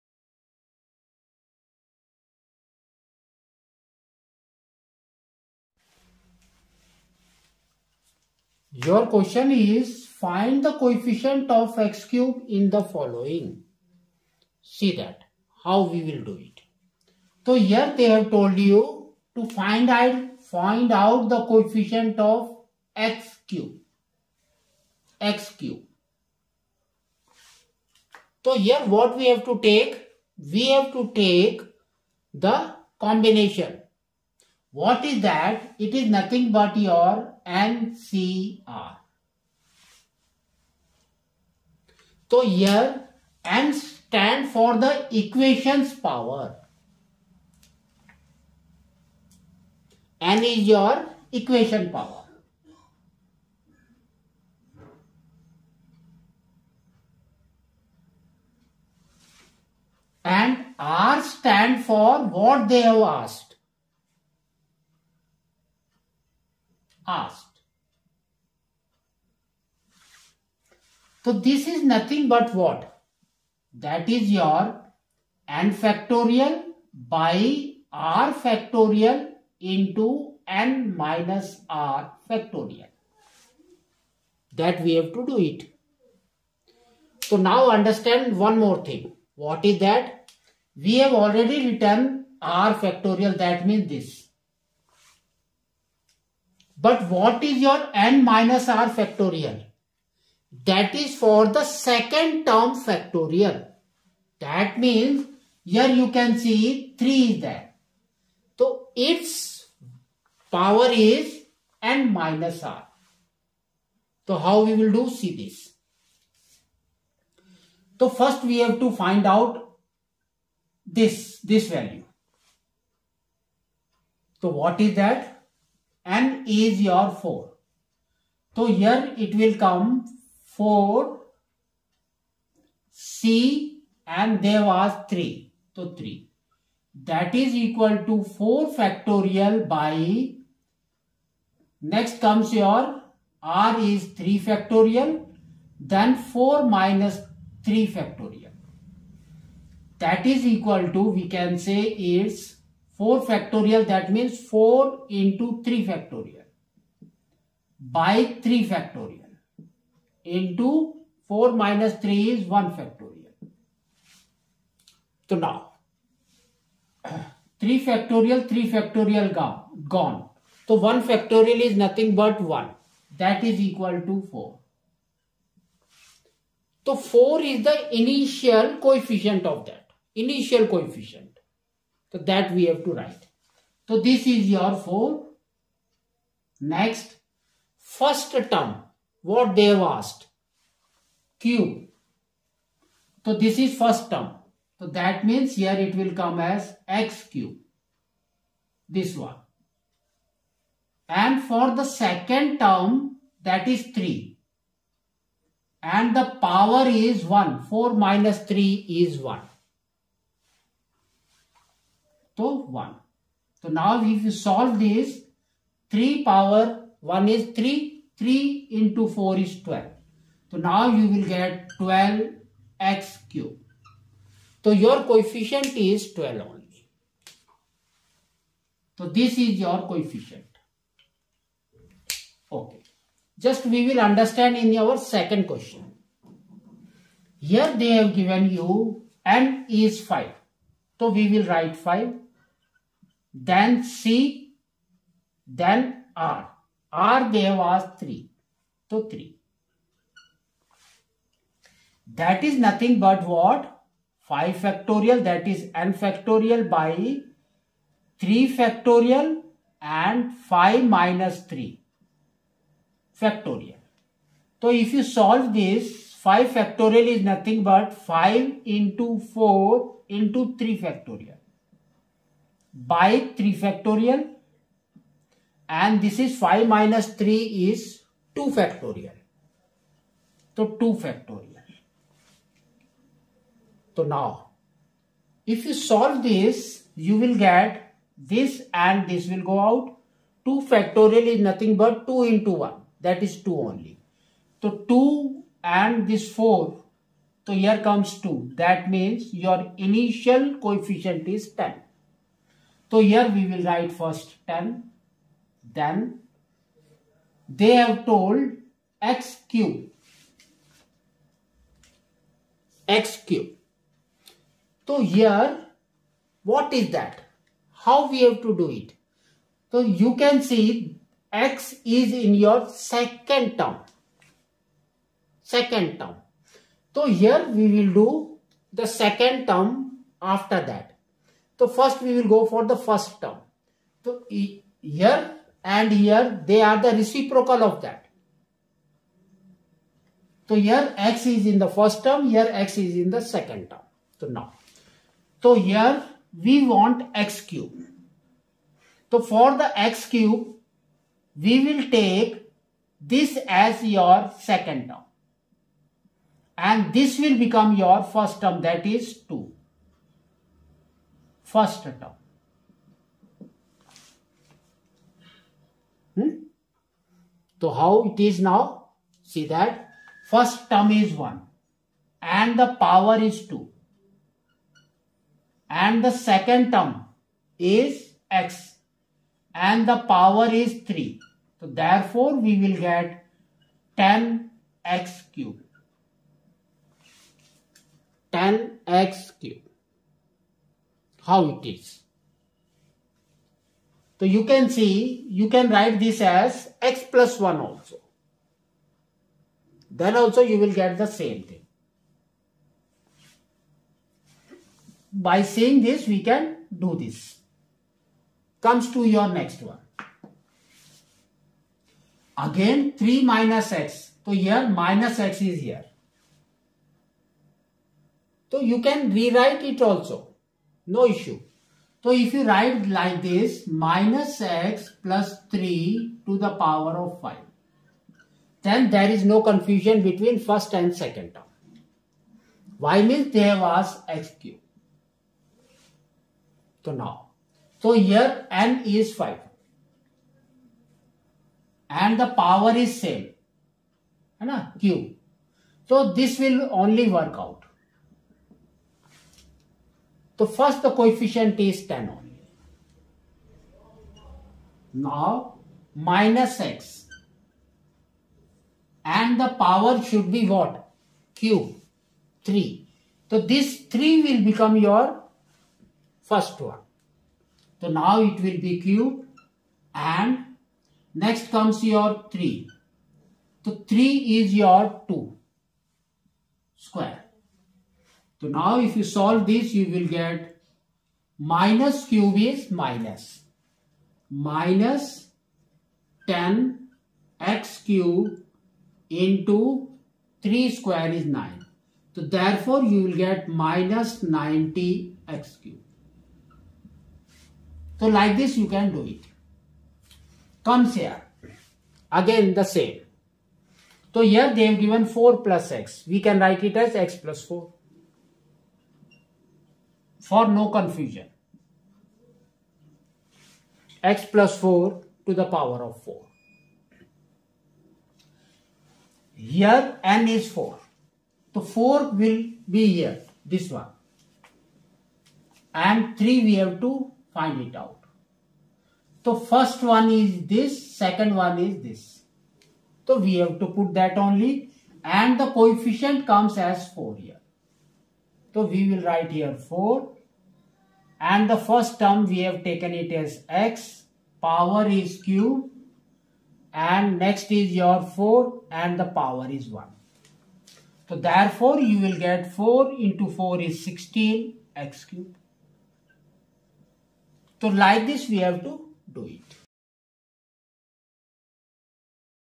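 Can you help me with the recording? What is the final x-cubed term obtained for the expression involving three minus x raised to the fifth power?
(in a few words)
-90x cube.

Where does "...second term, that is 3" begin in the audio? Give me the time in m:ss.
3:21.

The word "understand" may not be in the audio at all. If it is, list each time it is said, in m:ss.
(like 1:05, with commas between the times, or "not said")
1:27, 3:53.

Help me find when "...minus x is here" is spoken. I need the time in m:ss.
6:54.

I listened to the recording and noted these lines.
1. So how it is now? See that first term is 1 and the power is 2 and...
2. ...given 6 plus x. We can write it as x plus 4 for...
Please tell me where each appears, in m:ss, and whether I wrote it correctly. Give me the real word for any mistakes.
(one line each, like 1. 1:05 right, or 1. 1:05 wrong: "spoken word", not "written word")
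1. 6:07 right
2. 8:24 wrong: "4", not "6".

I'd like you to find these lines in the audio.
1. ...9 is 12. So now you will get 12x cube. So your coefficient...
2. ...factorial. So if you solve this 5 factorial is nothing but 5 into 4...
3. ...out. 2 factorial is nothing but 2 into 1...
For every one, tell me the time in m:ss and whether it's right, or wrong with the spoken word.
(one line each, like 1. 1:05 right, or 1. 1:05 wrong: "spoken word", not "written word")
1. 3:39 wrong: "4", not "9"
2. 4:23 right
3. 4:49 right.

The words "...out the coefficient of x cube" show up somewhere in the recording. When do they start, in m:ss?
0:20.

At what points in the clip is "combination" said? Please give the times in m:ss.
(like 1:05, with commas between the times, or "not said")
0:32.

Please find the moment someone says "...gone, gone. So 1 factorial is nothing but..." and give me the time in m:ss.
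2:49.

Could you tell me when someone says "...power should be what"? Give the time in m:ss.
7:39.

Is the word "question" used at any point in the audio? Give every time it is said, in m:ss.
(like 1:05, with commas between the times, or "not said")
0:09, 3:55.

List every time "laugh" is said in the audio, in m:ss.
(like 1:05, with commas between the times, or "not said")
not said.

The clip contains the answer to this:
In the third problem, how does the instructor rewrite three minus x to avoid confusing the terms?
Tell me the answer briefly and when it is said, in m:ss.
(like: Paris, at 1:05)
minus x plus 3, at 7:03.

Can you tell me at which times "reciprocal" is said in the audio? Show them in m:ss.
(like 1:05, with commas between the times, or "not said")
5:36.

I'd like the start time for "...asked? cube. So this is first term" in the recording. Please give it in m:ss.
3:09.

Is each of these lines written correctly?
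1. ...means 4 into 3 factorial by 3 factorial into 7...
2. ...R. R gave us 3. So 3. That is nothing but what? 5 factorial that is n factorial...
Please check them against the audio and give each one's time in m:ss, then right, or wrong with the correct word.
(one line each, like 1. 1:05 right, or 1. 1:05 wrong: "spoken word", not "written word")
1. 2:34 wrong: "4", not "7"
2. 4:06 right.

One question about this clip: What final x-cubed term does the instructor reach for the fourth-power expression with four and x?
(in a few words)
16x cube.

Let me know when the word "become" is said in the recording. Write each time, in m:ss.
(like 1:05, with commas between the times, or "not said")
5:57, 7:44.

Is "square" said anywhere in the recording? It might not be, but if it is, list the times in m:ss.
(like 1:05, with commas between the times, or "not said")
7:56, 8:10.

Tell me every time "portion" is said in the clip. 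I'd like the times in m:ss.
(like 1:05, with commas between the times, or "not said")
not said.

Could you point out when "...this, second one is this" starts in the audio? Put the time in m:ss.
8:50.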